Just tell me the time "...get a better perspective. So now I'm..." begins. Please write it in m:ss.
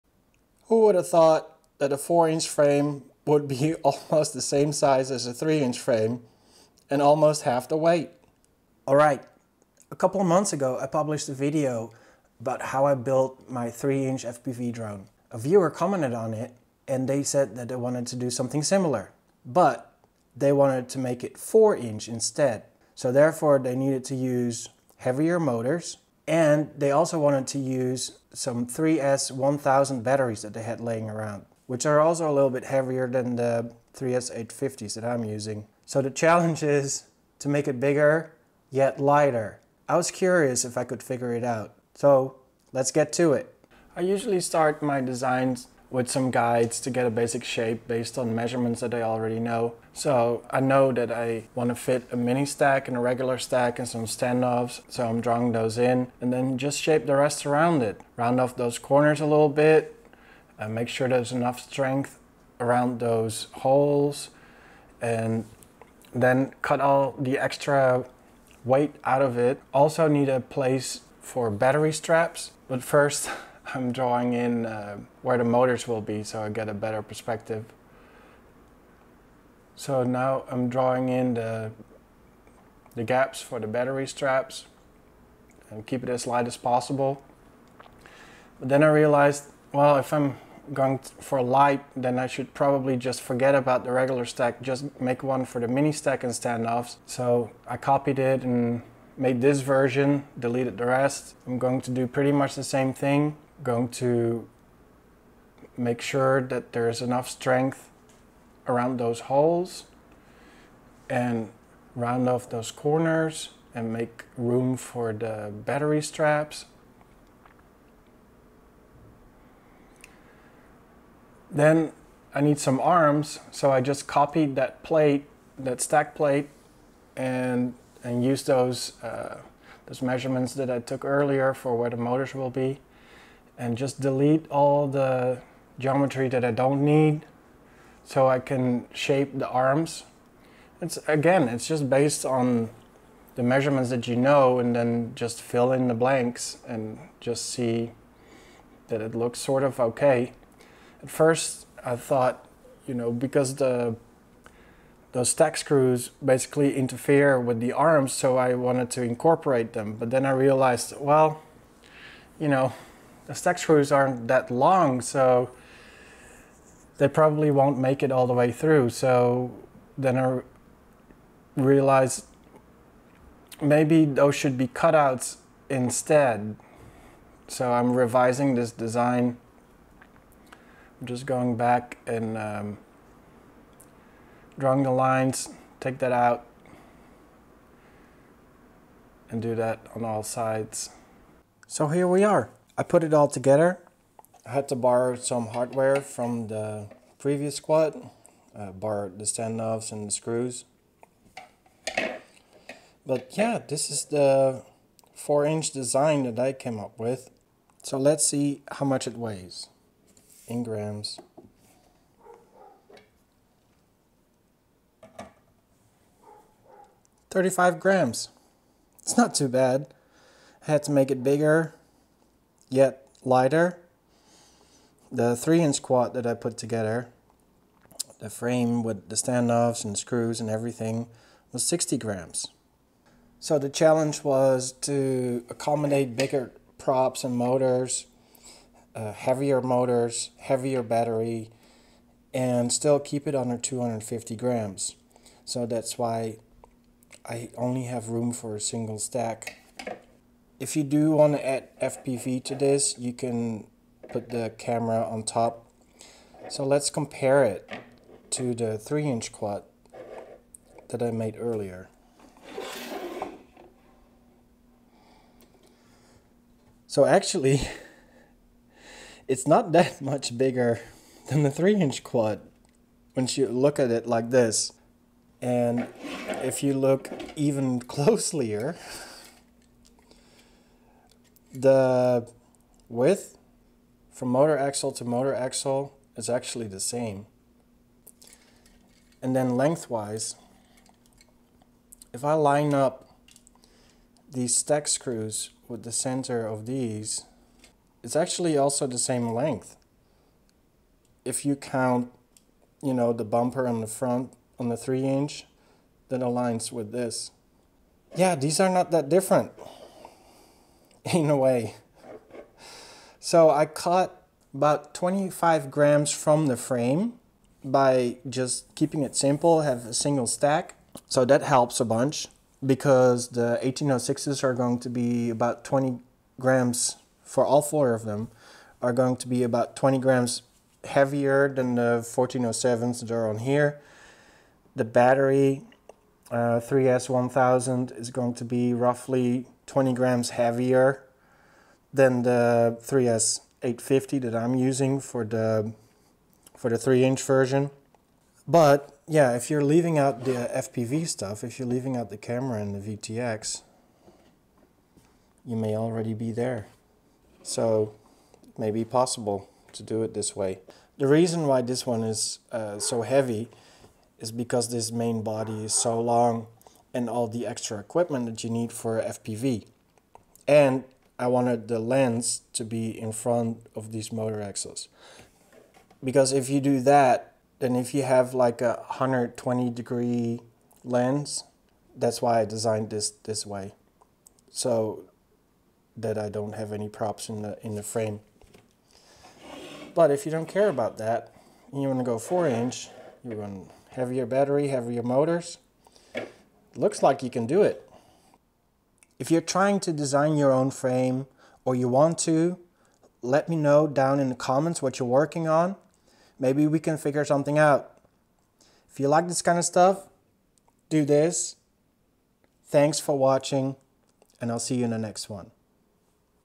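1:16.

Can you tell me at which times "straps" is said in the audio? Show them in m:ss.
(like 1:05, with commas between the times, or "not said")
1:11, 1:24, 1:56.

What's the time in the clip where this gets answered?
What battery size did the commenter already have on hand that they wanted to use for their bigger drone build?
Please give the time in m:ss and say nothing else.
0:28.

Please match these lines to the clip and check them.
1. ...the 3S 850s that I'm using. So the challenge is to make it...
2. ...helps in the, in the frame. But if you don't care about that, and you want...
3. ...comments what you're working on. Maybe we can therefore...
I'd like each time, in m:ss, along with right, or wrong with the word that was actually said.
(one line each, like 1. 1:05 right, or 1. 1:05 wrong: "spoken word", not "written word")
1. 0:33 right
2. 6:26 wrong: "props", not "helps"
3. 6:44 wrong: "figure", not "therefore".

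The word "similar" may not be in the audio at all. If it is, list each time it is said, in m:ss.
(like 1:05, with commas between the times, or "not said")
0:18.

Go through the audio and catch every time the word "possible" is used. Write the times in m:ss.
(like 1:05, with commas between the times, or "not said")
1:26, 5:58.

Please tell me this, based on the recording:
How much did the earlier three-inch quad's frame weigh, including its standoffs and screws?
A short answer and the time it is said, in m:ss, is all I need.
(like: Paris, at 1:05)
60 grams, at 3:51.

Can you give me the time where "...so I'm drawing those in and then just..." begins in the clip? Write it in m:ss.
0:54.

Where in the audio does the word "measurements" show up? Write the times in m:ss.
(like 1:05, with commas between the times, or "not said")
0:48, 2:10, 2:23.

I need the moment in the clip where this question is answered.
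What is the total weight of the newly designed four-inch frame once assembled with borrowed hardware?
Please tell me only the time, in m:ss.
3:37.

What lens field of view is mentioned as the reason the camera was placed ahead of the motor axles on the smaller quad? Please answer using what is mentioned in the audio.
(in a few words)
120 degrees.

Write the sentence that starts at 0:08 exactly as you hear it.
All right, a couple of months ago I published a video about how I built my 3-inch FPV drone.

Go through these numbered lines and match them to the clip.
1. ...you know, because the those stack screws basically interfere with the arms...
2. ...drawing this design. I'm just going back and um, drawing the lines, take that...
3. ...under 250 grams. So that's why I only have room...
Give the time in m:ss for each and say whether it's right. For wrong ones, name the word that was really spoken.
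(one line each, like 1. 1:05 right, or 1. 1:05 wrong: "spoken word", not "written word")
1. 2:32 right
2. 2:57 wrong: "revising", not "drawing"
3. 4:03 right.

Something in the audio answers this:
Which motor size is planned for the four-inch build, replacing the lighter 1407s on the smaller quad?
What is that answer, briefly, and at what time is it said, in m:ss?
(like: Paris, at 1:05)
1806, at 5:23.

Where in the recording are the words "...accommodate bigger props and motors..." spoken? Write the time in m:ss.
3:55.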